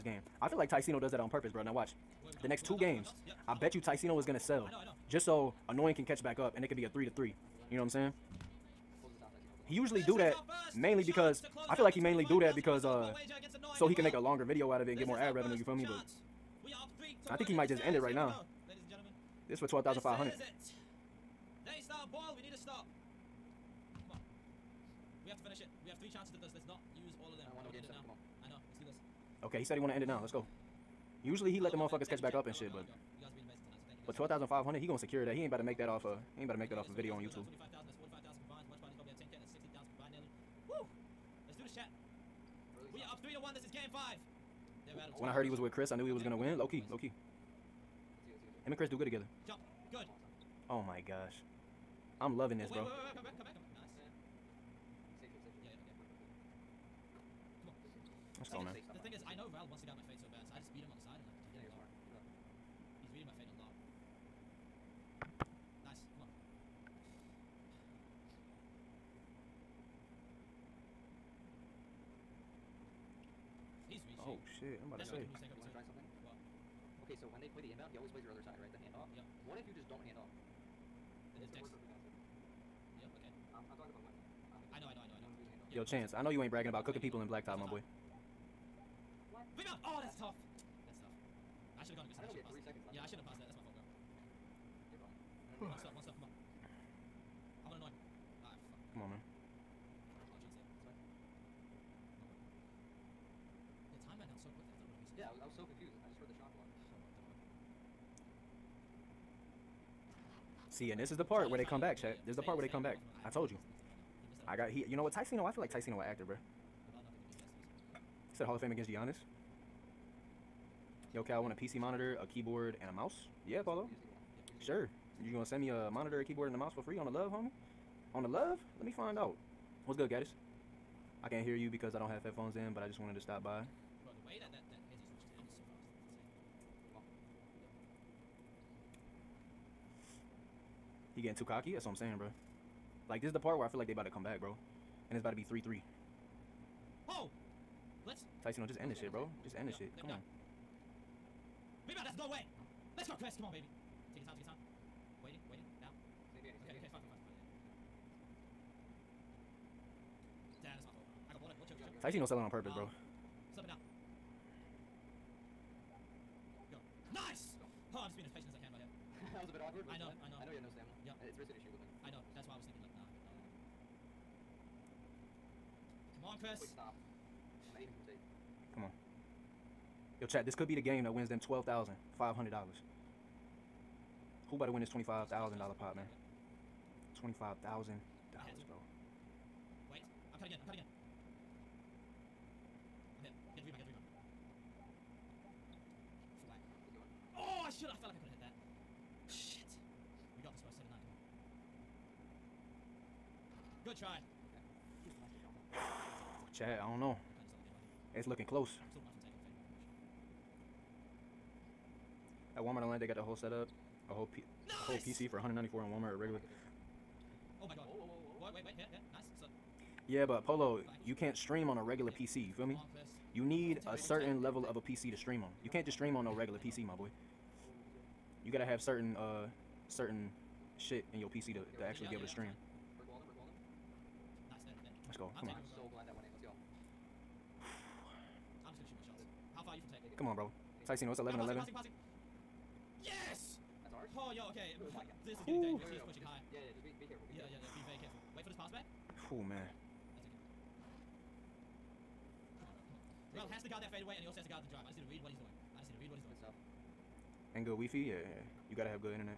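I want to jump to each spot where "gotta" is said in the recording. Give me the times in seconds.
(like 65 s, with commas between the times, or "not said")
228 s, 258 s.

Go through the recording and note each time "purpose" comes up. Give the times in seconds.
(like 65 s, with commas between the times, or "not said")
1 s, 162 s.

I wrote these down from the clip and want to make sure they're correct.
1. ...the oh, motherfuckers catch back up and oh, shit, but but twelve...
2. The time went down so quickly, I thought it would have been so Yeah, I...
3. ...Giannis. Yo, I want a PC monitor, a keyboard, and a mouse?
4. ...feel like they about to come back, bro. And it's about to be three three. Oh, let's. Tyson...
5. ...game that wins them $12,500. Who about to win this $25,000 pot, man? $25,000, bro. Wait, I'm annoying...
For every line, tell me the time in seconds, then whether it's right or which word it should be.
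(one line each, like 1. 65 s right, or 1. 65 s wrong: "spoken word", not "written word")
1. 31 s right
2. 103 s right
3. 118 s right
4. 143 s right
5. 180 s wrong: "cutting", not "annoying".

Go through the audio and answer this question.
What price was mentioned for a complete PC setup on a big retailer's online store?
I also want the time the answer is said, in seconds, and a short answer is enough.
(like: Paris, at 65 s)
194, at 215 s.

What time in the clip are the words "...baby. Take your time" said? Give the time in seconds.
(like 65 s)
153 s.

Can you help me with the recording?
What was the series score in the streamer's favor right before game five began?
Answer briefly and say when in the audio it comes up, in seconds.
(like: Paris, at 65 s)
3 to 1, at 43 s.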